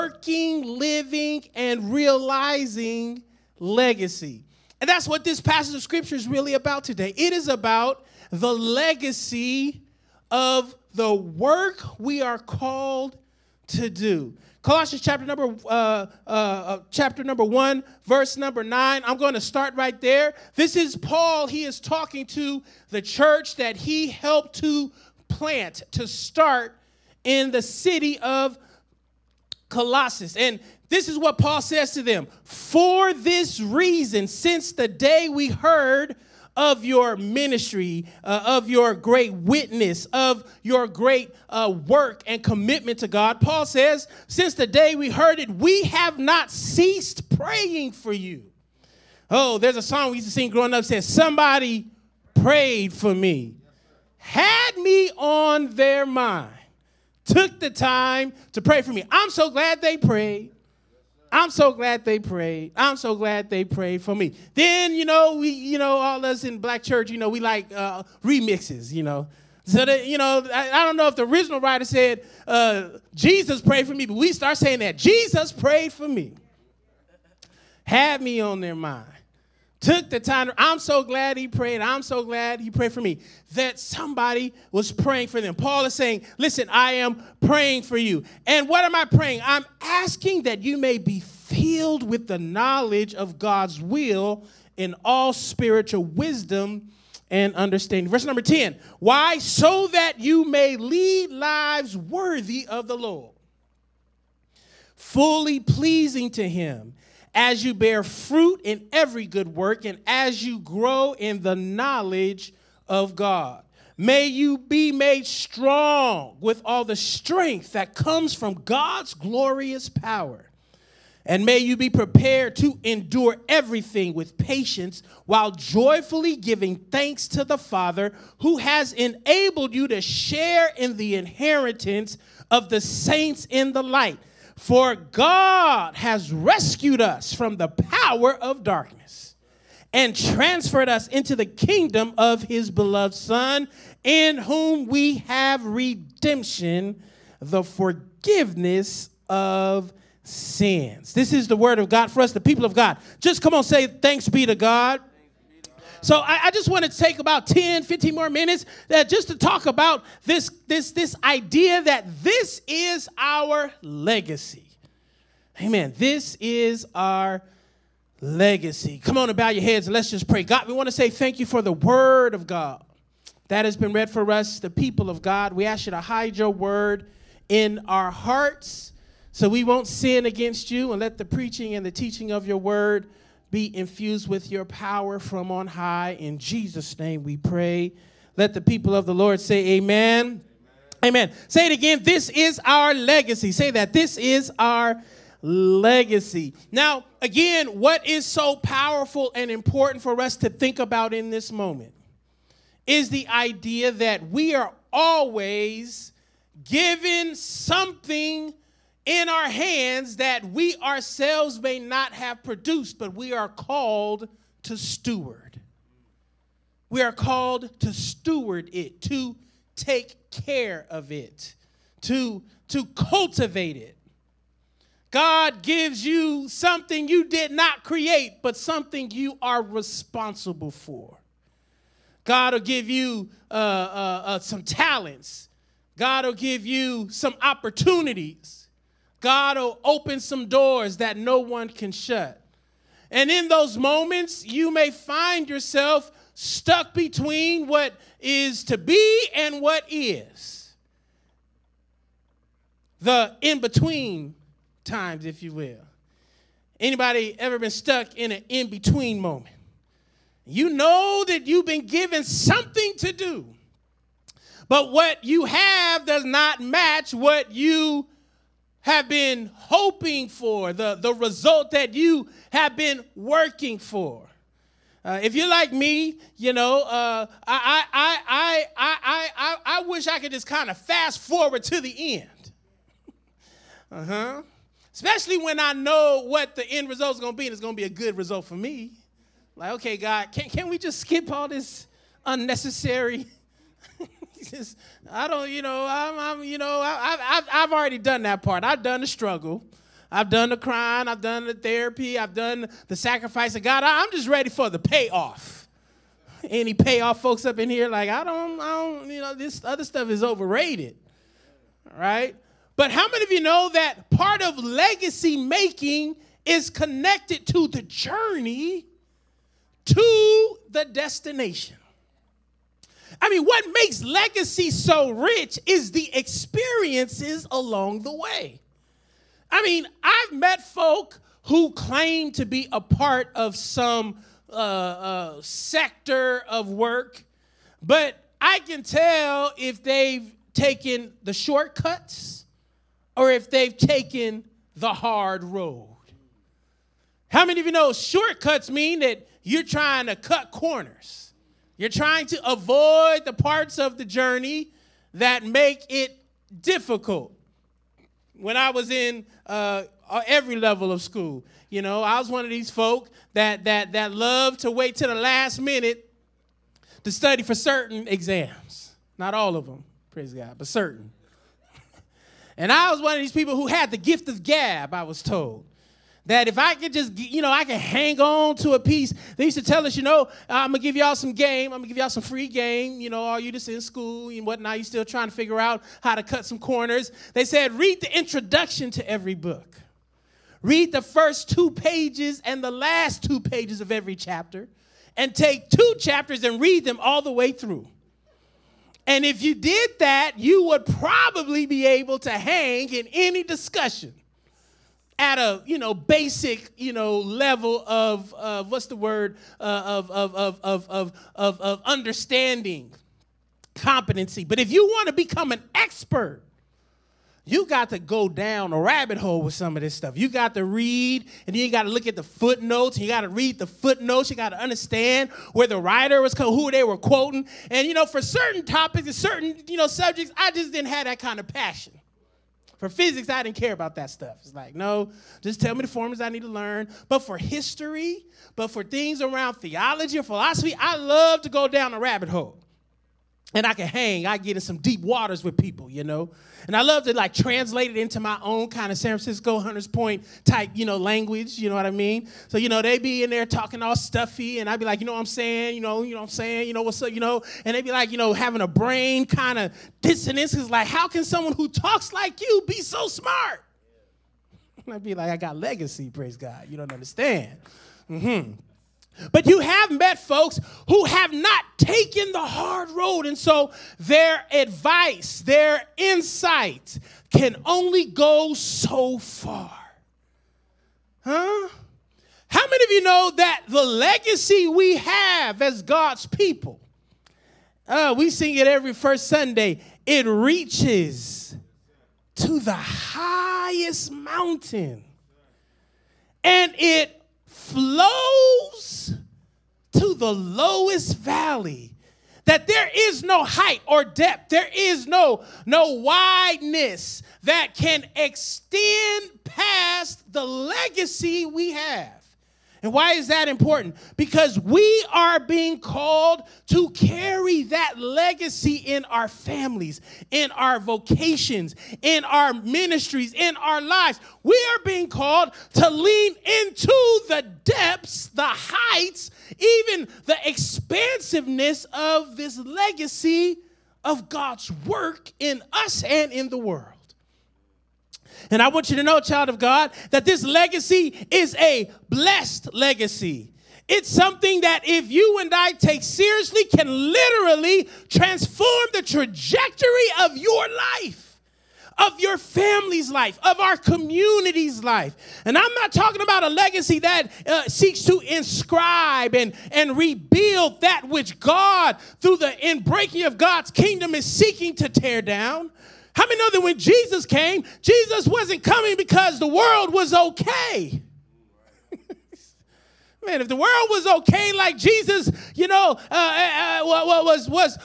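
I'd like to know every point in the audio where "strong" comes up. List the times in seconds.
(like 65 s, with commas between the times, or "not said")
115 s.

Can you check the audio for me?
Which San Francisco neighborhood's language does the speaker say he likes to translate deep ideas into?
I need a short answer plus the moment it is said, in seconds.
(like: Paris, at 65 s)
Hunters Point, at 449 s.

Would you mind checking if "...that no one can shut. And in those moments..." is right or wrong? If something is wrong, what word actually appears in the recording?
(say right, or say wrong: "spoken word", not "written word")
right.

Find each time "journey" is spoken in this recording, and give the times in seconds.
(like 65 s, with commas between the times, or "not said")
317 s, 354 s.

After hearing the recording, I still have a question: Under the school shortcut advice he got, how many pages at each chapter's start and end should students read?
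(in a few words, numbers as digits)
2.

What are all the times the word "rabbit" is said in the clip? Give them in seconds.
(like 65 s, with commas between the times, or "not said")
418 s, 441 s.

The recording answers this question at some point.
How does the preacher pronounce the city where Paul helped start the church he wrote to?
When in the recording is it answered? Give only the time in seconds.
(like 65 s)
29 s.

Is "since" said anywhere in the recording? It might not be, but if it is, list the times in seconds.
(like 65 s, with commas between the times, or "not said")
34 s, 44 s.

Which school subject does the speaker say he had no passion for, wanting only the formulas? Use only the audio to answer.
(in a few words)
Physics.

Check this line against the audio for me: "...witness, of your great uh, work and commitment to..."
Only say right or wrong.
right.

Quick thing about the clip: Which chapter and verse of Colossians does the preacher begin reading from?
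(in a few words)
Chapter 1, verse 9.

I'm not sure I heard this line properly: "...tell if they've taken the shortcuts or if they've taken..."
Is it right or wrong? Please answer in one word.
right.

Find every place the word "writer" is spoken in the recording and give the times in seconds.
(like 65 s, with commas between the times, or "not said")
71 s, 425 s.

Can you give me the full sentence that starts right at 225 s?
God gives you something you did not create, but something you are responsible for.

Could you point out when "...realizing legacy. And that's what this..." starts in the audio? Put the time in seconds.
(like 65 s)
1 s.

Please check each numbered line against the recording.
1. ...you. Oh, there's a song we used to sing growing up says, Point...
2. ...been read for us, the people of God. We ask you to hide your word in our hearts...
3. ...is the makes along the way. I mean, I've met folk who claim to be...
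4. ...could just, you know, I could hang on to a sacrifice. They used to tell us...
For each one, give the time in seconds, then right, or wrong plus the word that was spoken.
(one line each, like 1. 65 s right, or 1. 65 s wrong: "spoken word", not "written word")
1. 48 s wrong: "Somebody", not "Point"
2. 173 s right
3. 325 s wrong: "experiences", not "makes"
4. 376 s wrong: "piece", not "sacrifice".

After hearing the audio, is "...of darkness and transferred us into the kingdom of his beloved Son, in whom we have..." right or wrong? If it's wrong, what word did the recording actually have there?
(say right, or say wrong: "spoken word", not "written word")
right.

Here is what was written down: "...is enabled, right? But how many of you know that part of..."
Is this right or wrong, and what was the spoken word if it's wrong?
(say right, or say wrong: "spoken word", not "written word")
wrong: "overrated", not "enabled".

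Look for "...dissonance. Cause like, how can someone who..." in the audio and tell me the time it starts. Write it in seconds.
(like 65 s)
459 s.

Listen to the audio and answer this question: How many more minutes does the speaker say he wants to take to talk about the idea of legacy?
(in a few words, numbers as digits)
10 to 15 minutes.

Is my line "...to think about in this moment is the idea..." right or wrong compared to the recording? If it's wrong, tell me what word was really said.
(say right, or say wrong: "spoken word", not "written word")
right.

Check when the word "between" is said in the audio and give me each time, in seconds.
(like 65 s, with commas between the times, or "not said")
246 s, 253 s, 258 s.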